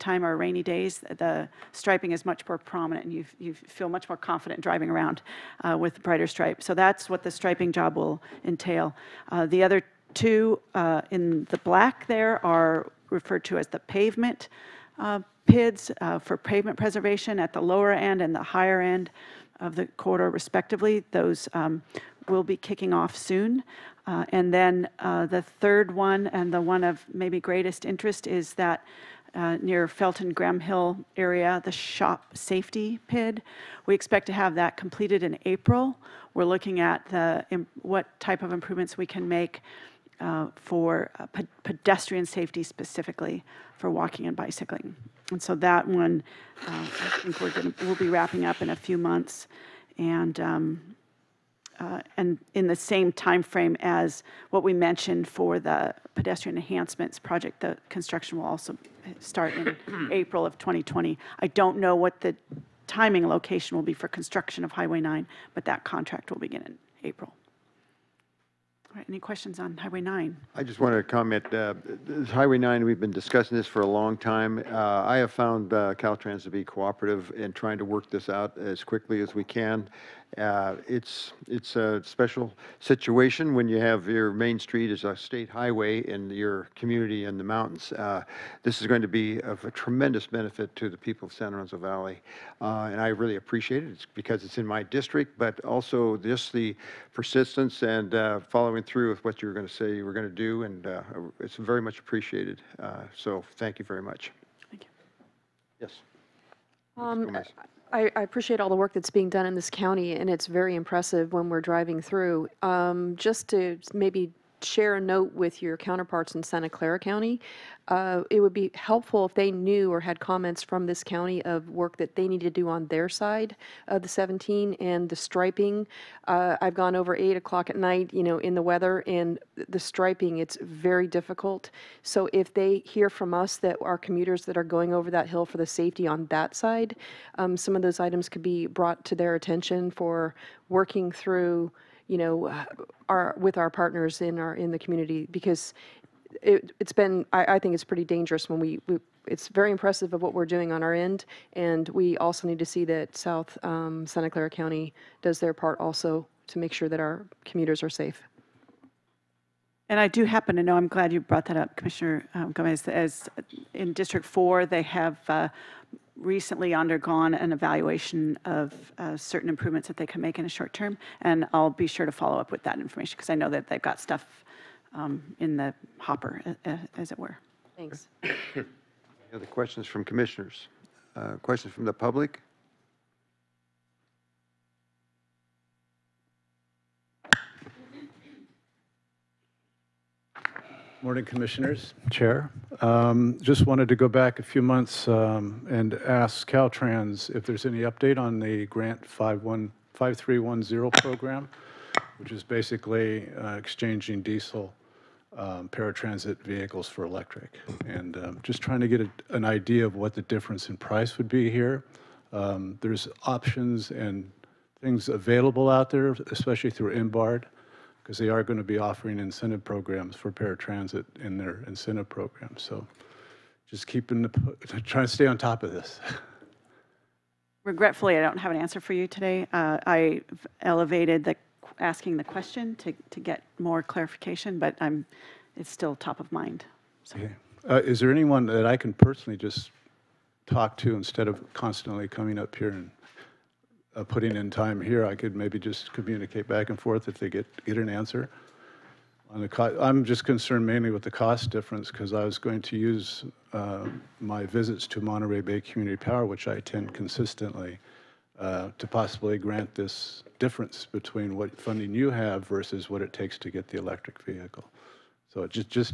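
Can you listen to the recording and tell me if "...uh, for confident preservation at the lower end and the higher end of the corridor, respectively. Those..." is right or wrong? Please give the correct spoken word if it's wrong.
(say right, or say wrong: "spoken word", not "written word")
wrong: "pavement", not "confident".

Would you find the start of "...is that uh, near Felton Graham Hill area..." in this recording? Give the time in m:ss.
0:28.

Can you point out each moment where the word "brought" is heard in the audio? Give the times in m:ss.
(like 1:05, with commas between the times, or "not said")
2:18, 2:41.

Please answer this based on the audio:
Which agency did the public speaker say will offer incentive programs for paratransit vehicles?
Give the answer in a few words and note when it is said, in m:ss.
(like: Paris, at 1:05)
MBARD, at 3:37.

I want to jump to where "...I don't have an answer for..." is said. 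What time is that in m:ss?
3:48.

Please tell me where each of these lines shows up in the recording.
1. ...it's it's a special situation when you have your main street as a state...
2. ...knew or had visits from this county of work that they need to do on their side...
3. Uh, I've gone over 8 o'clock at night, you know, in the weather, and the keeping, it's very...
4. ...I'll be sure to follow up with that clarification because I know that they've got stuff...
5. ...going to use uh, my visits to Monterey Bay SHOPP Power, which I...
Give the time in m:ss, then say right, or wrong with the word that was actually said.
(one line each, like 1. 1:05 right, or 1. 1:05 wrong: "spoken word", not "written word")
1. 1:20 right
2. 1:59 wrong: "comments", not "visits"
3. 2:06 wrong: "striping", not "keeping"
4. 2:51 wrong: "information", not "clarification"
5. 4:12 wrong: "Community", not "SHOPP".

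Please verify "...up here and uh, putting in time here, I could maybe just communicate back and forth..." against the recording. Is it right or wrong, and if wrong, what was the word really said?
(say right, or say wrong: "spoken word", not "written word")
right.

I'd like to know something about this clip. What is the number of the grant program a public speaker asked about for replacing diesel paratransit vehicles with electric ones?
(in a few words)
5310.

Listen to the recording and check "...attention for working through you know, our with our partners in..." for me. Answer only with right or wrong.
right.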